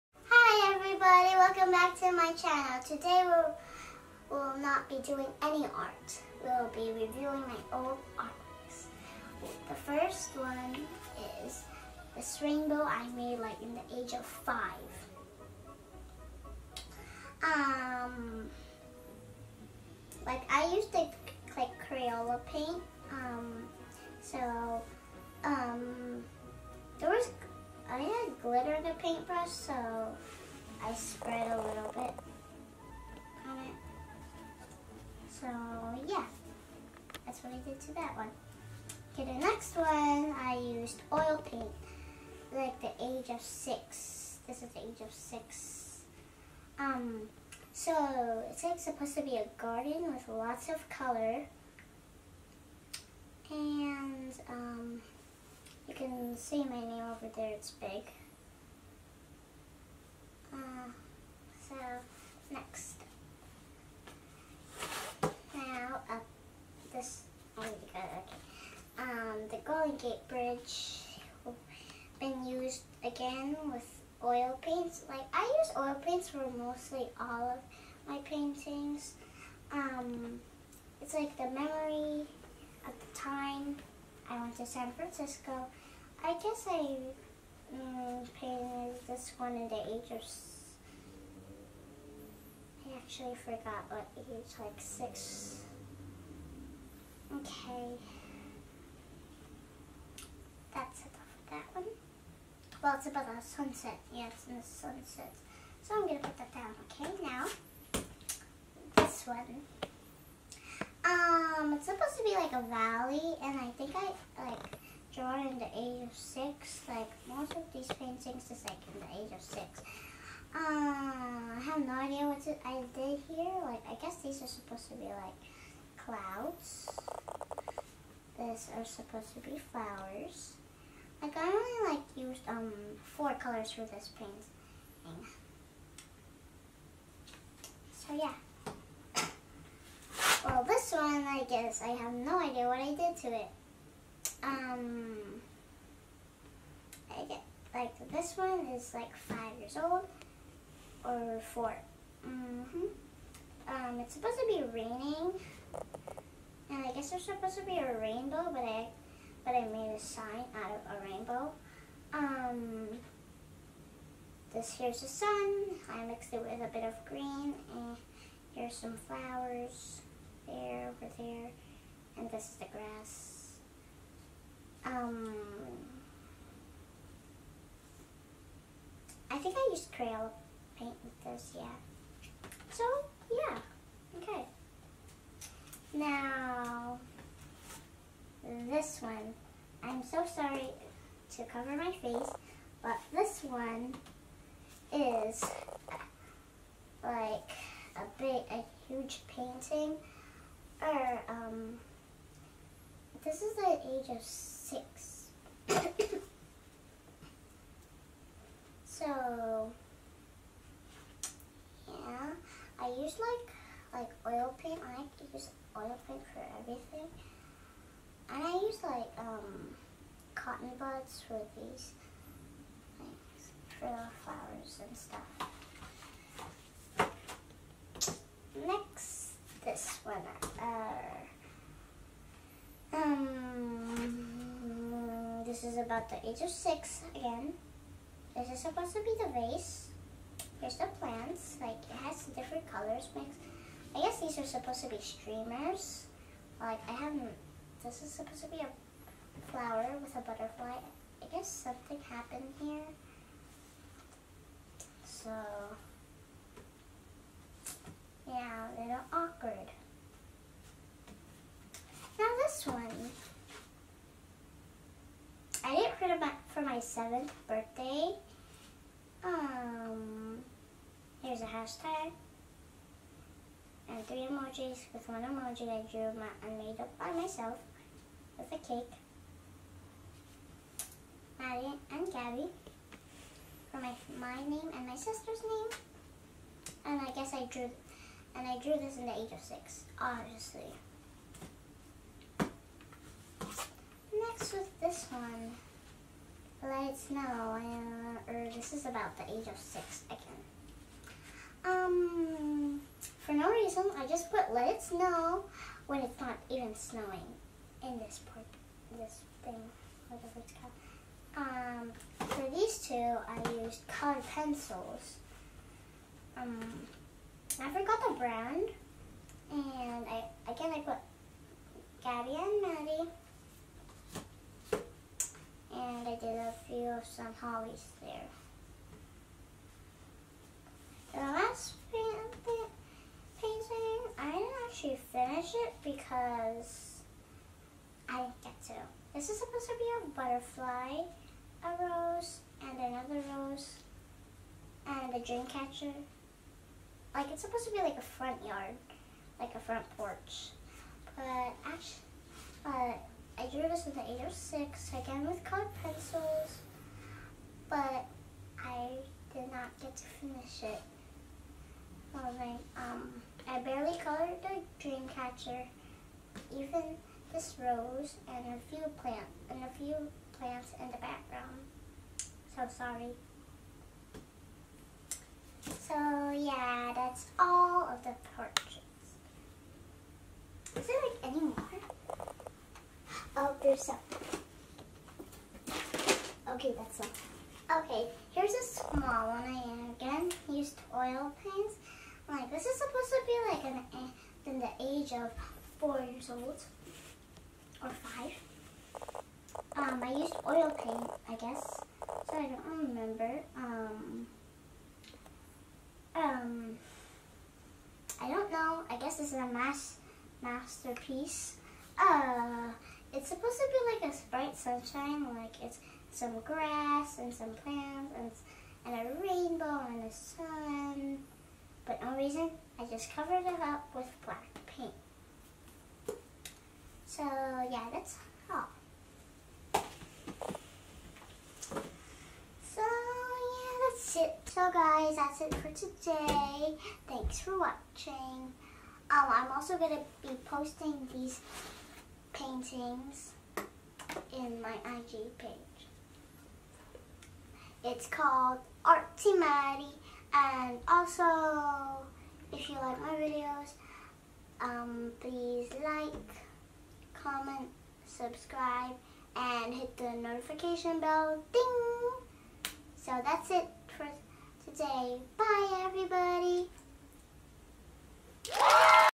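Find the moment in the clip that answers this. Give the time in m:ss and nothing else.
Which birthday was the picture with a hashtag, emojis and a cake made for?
4:26.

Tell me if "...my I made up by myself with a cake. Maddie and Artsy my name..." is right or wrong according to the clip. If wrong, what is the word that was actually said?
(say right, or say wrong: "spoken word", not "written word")
wrong: "Gabby", not "Artsy".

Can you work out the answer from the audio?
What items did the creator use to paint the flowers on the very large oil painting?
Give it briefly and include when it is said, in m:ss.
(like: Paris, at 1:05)
Cotton buds, at 3:40.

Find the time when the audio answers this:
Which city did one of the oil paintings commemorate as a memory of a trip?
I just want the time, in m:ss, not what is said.
1:24.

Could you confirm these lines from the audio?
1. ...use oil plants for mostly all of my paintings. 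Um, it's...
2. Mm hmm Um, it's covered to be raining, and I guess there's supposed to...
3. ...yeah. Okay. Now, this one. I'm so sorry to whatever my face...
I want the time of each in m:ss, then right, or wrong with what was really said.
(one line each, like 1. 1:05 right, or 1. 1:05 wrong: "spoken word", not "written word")
1. 1:15 wrong: "paints", not "plants"
2. 2:32 wrong: "supposed", not "covered"
3. 3:03 wrong: "cover", not "whatever".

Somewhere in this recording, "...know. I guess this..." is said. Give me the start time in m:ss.
6:48.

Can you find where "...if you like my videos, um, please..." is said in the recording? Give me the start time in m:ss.
7:32.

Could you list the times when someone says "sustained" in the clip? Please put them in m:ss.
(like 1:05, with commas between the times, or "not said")
not said.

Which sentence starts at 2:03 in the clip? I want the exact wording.
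Like, I guess these are supposed to be, like, clouds.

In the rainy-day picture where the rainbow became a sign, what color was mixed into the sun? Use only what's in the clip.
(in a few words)
Green.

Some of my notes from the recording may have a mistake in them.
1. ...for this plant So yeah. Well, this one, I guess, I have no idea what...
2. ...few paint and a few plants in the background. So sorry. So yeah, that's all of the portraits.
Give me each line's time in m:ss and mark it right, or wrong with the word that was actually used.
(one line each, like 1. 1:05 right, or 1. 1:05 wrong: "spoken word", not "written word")
1. 2:13 wrong: "paint", not "plant"
2. 6:08 wrong: "plant", not "paint".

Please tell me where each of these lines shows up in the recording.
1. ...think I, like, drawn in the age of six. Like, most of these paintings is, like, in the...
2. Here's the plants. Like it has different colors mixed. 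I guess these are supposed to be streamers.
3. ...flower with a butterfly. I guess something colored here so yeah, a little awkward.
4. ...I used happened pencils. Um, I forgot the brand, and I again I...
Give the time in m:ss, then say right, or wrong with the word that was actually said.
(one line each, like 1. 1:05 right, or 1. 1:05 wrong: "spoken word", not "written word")
1. 1:53 right
2. 4:00 right
3. 4:09 wrong: "happened", not "colored"
4. 5:12 wrong: "colored", not "happened".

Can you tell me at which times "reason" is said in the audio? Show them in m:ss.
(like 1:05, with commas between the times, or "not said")
5:03, 7:02.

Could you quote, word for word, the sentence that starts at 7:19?
Um, I'm also going to be posting these paintings in my IG page.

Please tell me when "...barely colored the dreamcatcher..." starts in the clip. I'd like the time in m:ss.
6:03.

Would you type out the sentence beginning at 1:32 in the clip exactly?
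I actually forgot what age, like six.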